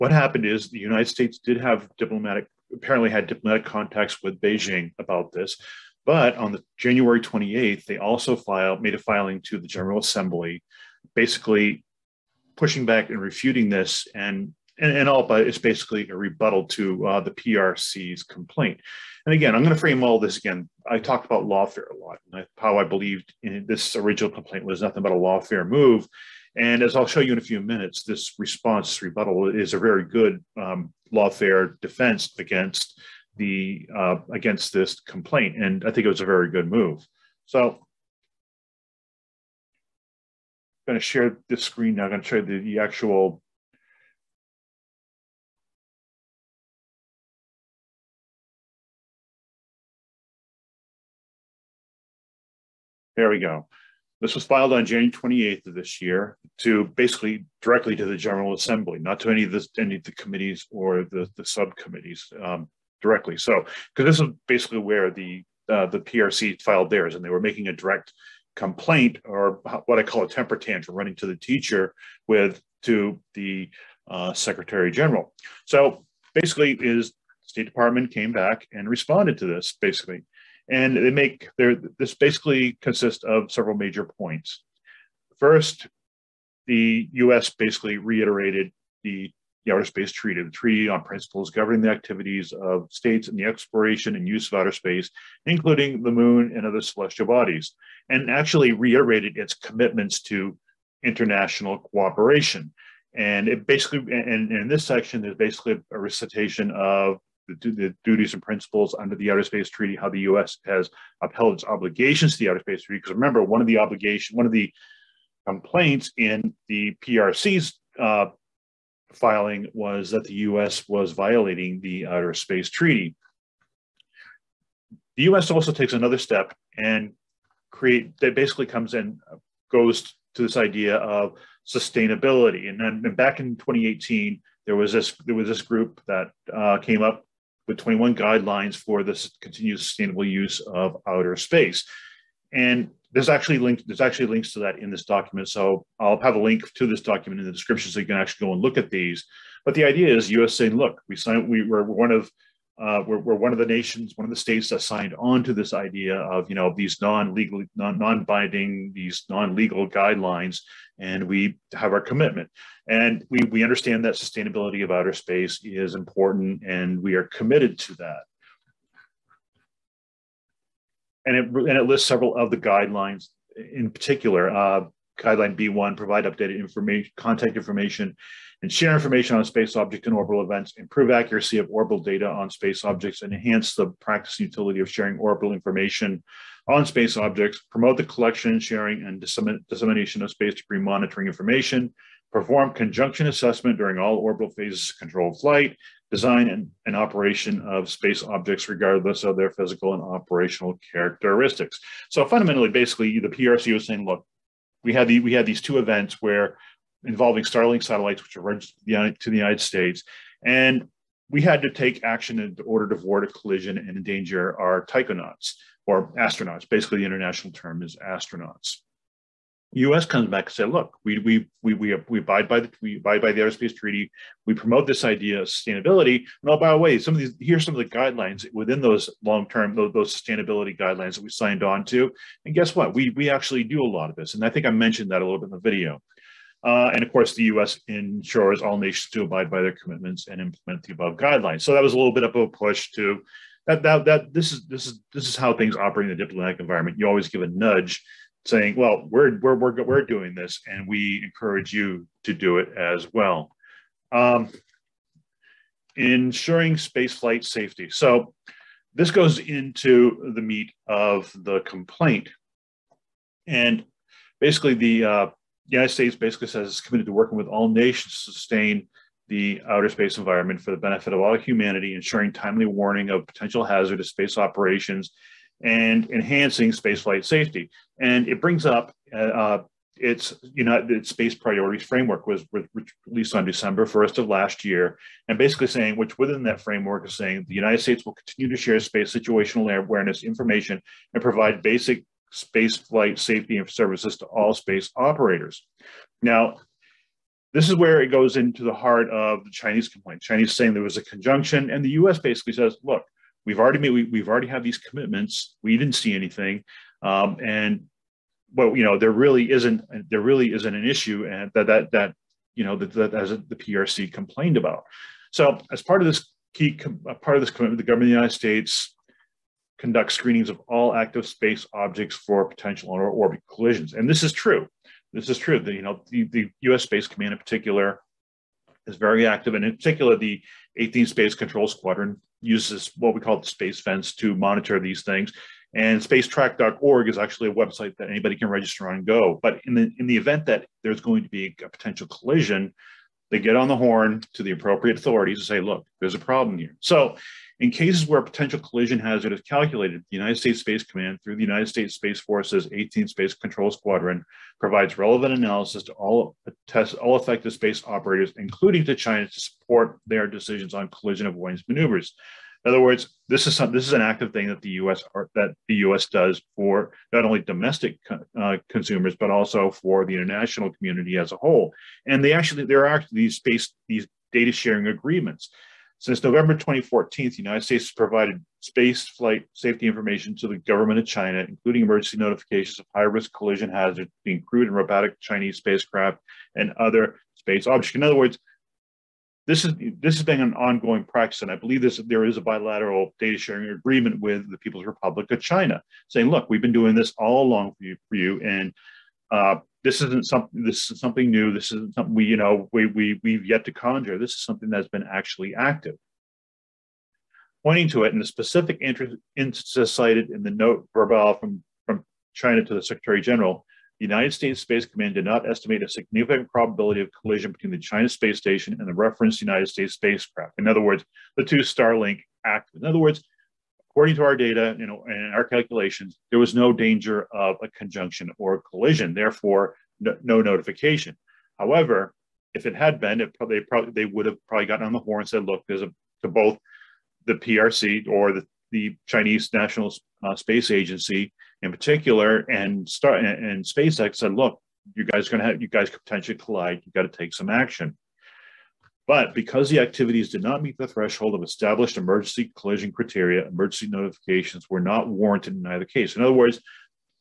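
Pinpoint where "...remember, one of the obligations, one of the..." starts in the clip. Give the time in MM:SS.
01:53.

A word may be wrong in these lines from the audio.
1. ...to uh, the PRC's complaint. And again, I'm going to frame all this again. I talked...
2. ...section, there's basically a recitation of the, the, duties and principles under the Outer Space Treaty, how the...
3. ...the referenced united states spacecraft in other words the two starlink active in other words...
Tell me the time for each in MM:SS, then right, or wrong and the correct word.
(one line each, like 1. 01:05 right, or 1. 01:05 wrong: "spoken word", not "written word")
1. 00:16 right
2. 01:44 right
3. 06:58 right.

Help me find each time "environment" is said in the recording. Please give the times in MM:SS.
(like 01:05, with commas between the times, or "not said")
04:06, 04:30.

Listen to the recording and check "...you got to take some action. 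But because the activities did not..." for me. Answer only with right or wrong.
right.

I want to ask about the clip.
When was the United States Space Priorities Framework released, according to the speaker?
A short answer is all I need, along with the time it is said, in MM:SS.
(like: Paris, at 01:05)
December 1st, at 04:43.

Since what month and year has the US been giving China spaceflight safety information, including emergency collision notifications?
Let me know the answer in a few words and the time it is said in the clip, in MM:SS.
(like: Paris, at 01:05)
November 2014, at 06:16.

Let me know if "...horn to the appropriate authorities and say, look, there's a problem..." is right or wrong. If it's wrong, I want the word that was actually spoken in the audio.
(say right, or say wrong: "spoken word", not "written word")
right.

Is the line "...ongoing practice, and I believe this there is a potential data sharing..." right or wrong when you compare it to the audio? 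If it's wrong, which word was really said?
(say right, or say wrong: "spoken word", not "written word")
wrong: "bilateral", not "potential".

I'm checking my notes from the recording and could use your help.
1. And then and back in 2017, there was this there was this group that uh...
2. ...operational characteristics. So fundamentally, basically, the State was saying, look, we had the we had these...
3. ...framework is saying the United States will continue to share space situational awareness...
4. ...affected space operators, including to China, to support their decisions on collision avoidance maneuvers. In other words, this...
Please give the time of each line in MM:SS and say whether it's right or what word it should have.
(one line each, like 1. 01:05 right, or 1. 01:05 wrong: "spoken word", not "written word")
1. 02:12 wrong: "2018", not "2017"
2. 03:20 wrong: "PRC", not "State"
3. 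04:46 right
4. 05:57 right.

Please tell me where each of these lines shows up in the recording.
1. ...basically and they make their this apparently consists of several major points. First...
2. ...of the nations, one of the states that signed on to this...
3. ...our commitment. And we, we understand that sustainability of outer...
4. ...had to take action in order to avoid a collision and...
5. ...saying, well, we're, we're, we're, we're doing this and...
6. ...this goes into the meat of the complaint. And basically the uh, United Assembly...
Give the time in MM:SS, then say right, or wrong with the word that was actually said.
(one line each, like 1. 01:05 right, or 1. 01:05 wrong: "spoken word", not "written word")
1. 01:19 wrong: "basically", not "apparently"
2. 02:33 right
3. 02:41 right
4. 03:31 right
5. 04:08 right
6. 04:18 wrong: "States", not "Assembly".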